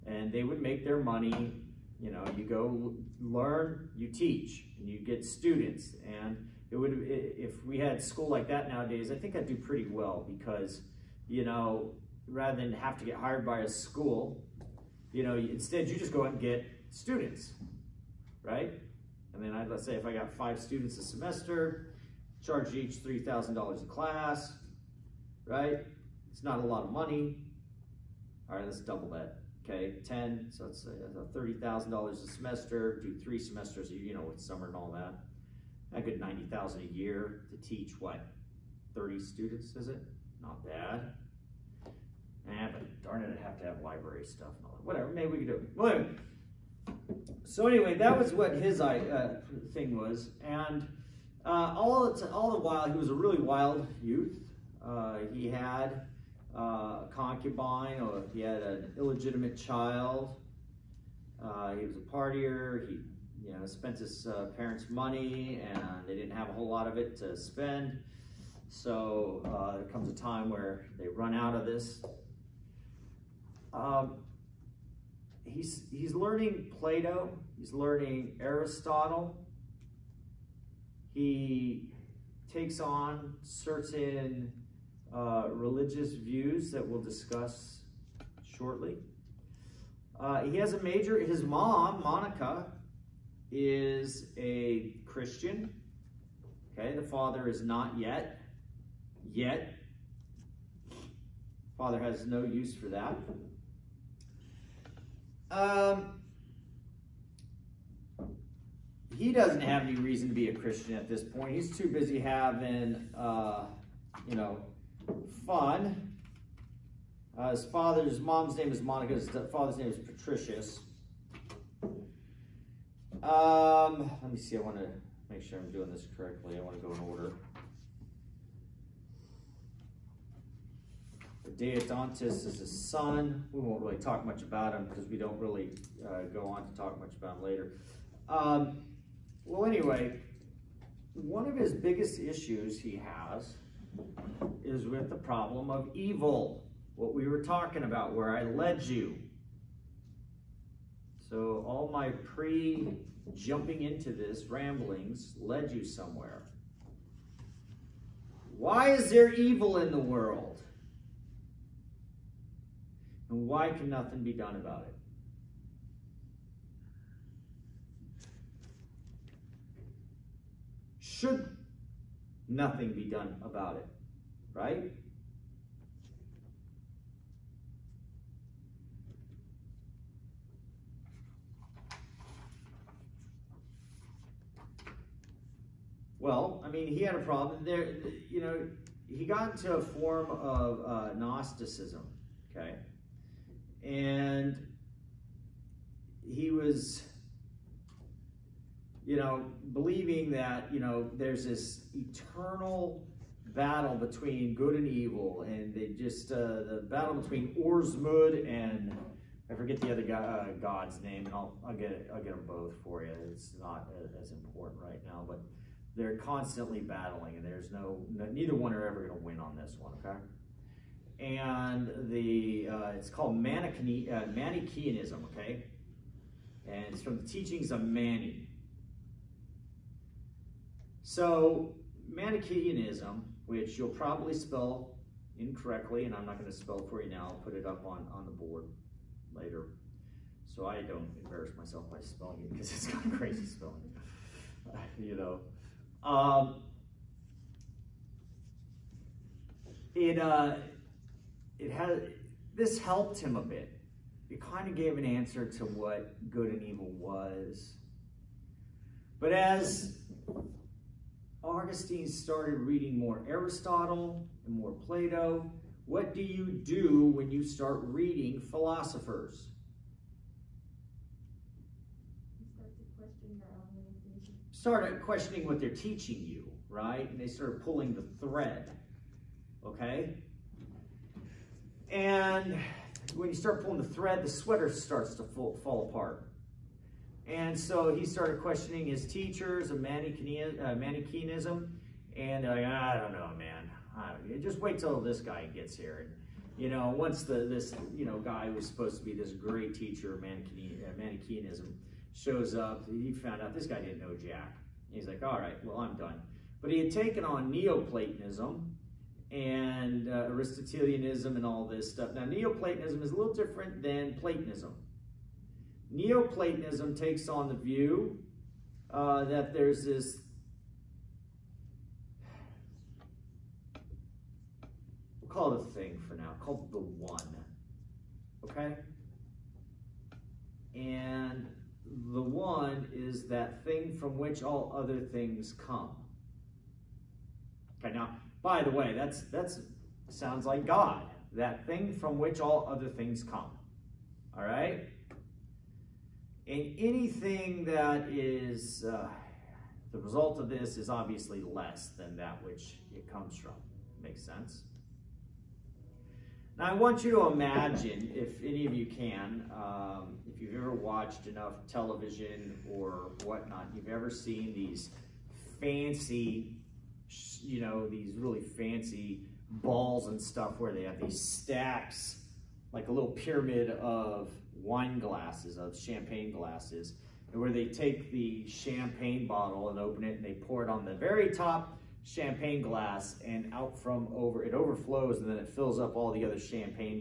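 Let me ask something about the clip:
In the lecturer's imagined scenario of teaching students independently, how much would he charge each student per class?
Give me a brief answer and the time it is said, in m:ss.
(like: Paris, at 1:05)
$3,000, at 0:23.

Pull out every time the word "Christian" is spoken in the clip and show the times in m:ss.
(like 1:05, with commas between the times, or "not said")
1:35, 1:50.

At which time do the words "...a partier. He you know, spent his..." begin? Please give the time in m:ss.
1:01.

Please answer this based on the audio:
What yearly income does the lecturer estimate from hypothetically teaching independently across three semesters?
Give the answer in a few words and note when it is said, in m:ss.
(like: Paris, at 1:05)
90000, at 0:36.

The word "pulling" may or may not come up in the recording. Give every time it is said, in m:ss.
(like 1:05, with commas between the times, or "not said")
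4:37, 4:43.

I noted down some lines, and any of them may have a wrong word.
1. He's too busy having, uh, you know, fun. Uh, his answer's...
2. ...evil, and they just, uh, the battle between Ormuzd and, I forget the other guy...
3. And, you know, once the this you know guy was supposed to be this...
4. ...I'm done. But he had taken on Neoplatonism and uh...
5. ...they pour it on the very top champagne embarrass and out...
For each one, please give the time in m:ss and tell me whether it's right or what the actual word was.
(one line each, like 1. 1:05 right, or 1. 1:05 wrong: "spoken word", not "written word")
1. 1:51 wrong: "father", not "answer"
2. 3:24 right
3. 4:56 right
4. 5:05 right
5. 6:20 wrong: "glass", not "embarrass".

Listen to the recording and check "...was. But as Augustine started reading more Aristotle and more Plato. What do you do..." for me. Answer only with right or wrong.
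right.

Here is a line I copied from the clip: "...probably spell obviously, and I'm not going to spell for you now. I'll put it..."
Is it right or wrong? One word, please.
wrong.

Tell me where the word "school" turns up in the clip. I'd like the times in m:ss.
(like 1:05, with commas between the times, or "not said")
0:08, 0:13.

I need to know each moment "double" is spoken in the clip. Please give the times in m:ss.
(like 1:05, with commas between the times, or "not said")
0:28.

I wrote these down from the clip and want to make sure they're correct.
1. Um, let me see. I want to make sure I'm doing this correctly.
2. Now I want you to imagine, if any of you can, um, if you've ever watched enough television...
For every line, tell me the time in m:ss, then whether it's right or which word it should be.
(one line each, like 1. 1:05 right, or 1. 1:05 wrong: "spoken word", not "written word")
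1. 2:03 right
2. 5:56 right.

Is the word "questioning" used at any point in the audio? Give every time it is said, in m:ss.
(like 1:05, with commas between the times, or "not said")
4:34, 4:48.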